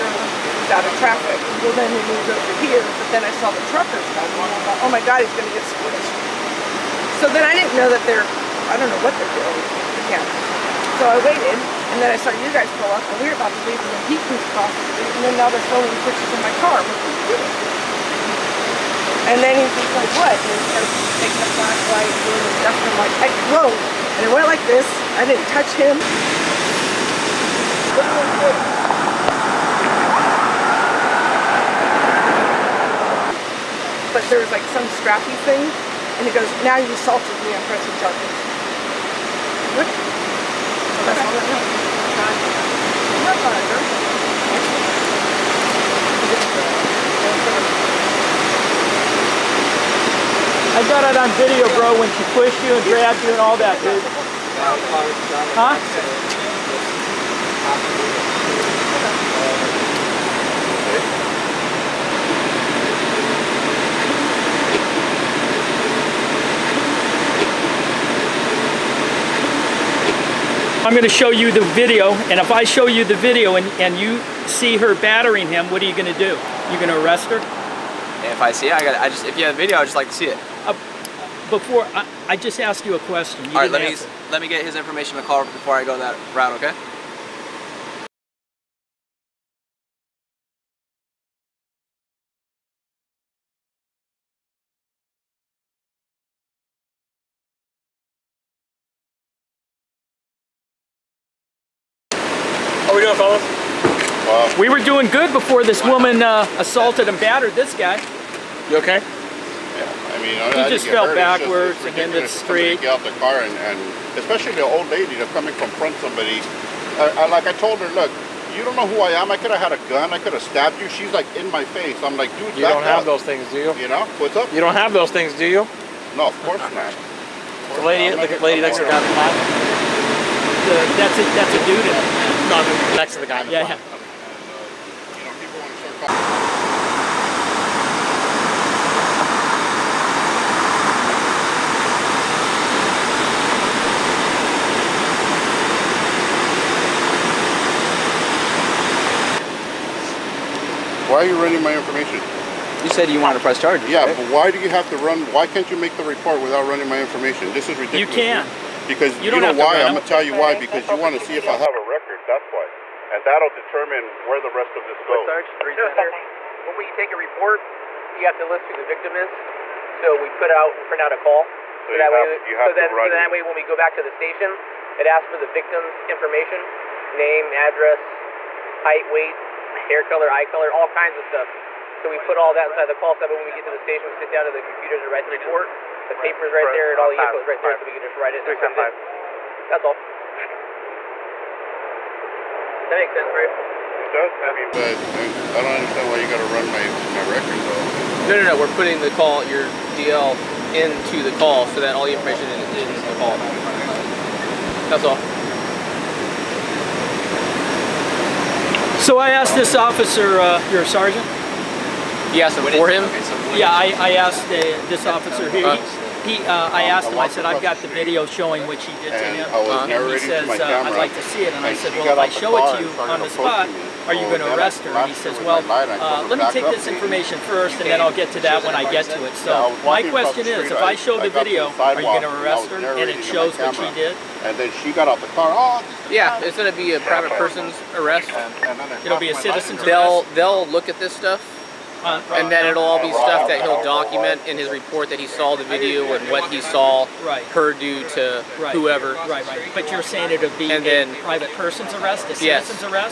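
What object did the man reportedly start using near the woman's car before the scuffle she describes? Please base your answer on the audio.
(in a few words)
flashlight.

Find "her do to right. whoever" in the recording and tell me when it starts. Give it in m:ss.
4:07.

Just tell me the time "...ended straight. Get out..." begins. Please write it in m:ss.
1:51.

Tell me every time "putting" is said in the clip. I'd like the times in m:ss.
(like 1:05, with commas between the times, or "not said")
3:18.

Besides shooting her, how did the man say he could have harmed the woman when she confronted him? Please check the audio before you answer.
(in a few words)
stabbed.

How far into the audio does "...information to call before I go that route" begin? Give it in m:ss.
1:24.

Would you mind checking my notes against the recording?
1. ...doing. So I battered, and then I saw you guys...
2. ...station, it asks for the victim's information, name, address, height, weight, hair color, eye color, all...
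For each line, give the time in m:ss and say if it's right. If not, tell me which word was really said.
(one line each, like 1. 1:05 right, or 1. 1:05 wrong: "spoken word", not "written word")
1. 0:09 wrong: "waited", not "battered"
2. 2:54 right.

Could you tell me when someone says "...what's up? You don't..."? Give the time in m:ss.
2:04.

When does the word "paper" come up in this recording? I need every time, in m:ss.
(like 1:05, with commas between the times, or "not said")
3:06.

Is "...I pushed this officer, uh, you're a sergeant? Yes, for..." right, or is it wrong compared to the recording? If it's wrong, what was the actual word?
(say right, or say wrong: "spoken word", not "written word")
wrong: "asked", not "pushed".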